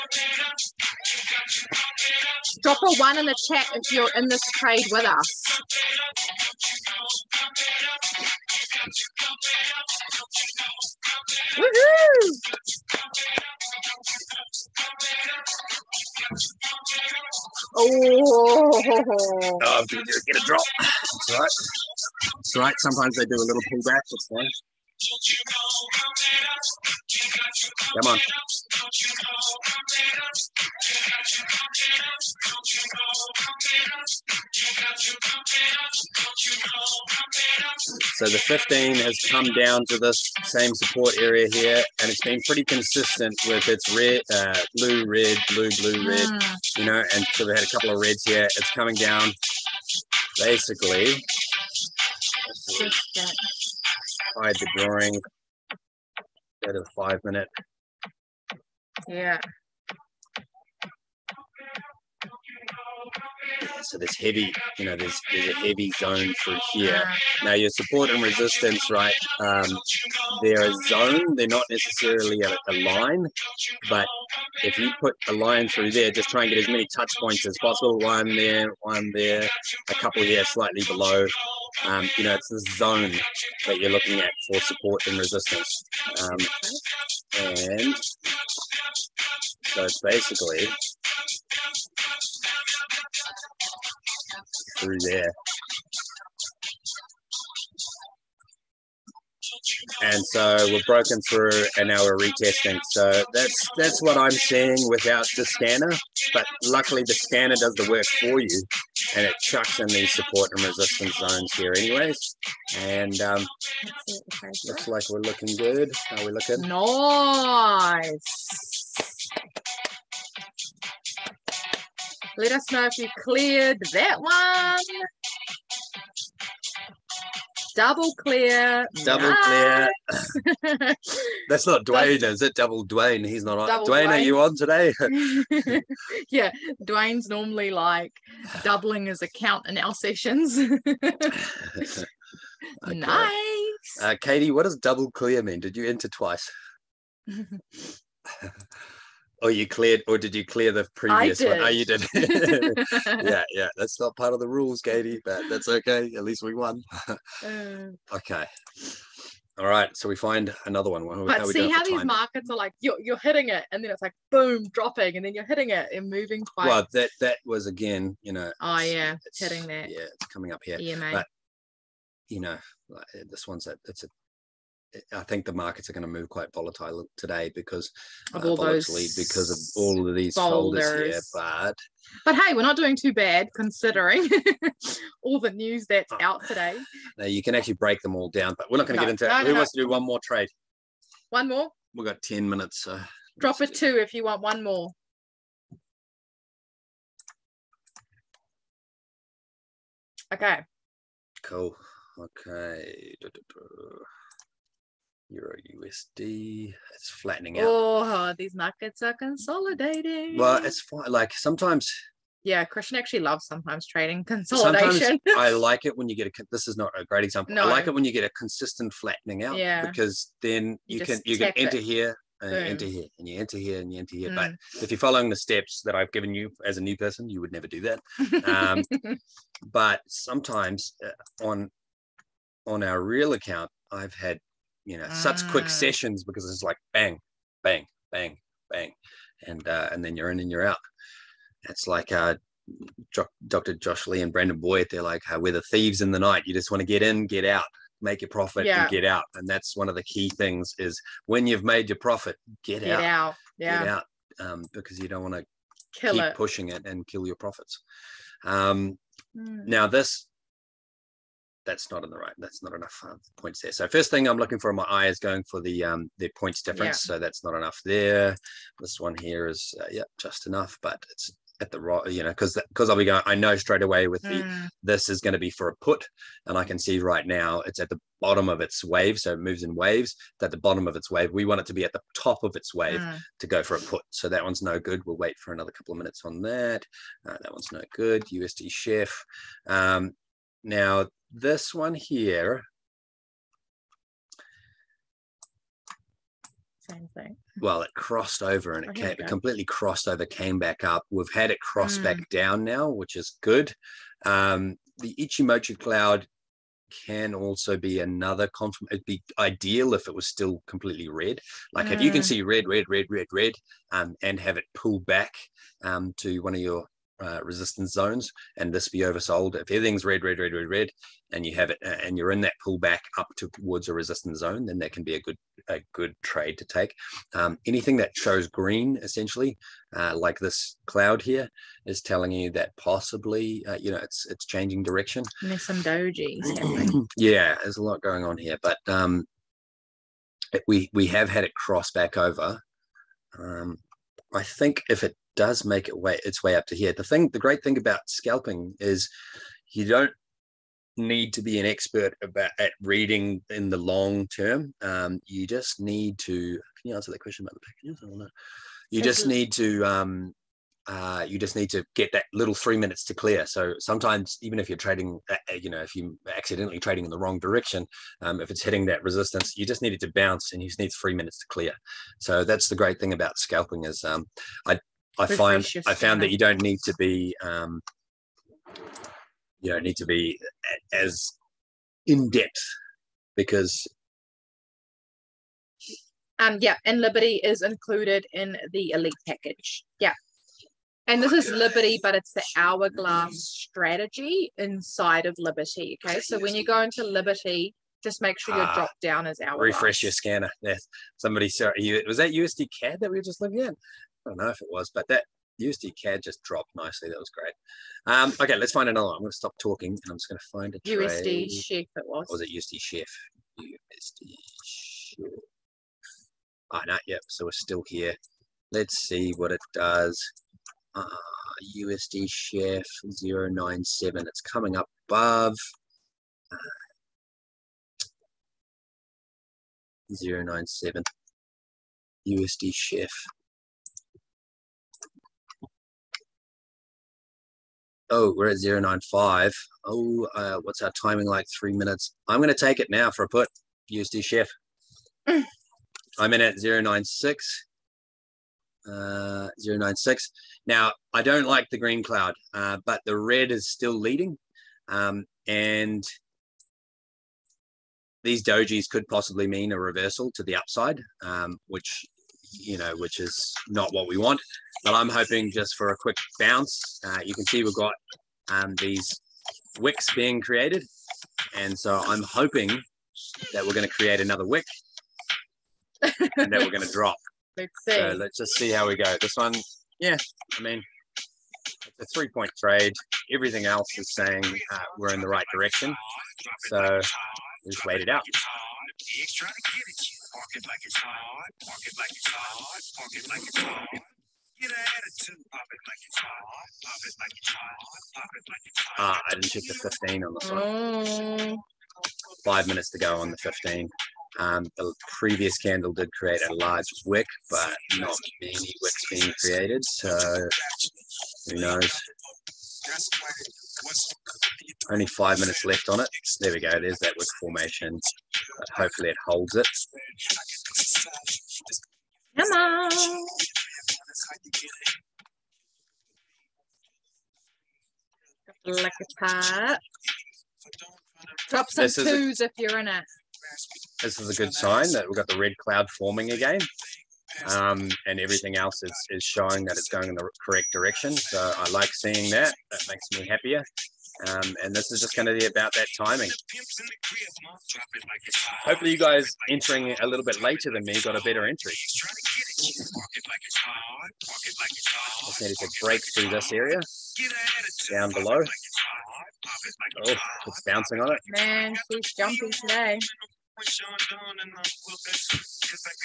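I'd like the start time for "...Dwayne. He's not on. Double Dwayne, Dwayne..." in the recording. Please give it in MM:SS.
02:12.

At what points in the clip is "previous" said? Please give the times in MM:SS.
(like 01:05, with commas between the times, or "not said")
02:30, 08:25.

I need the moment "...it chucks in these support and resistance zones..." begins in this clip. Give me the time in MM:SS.
01:49.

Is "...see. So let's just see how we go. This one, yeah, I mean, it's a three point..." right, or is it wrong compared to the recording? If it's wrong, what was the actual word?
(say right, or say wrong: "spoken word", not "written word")
right.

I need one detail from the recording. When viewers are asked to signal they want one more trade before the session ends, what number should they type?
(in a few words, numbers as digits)
2.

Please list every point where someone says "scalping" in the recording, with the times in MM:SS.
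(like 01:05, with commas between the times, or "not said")
05:48, 06:13.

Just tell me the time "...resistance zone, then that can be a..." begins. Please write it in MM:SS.
05:23.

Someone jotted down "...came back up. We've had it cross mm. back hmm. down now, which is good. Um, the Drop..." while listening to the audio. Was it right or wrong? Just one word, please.
wrong.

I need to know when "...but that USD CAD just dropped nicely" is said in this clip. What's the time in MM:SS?
06:44.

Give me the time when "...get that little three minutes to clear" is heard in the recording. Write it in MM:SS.
06:01.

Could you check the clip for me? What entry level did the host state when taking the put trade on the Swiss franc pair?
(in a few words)
096.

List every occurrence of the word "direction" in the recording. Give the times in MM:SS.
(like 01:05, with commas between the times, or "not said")
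05:34, 06:07, 08:05, 09:00.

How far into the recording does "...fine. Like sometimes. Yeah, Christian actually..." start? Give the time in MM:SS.
03:30.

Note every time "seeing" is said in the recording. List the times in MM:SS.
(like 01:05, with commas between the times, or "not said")
01:44, 09:01.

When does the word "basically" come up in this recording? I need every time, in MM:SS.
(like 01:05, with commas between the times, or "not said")
00:50, 01:30.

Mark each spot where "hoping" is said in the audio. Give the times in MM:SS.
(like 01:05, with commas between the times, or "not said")
07:45, 07:52.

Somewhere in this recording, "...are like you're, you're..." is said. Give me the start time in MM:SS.
02:42.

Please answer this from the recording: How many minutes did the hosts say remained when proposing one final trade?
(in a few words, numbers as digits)
10.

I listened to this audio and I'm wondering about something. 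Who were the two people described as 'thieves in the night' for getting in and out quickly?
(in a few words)
Dr. Josh Lee and Brandon Boyd.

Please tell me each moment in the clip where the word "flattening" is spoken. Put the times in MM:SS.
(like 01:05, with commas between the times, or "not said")
03:27, 03:38.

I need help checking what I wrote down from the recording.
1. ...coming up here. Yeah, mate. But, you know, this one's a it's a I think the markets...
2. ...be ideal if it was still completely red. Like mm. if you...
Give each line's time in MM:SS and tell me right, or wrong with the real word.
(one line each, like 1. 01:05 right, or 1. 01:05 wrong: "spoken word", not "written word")
1. 02:50 right
2. 05:09 right.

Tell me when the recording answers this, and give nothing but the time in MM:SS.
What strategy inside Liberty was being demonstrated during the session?
06:32.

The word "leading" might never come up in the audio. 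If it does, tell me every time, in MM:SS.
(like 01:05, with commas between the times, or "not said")
07:33.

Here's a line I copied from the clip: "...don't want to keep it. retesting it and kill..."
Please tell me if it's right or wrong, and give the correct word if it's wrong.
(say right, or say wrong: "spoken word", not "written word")
wrong: "pushing", not "retesting".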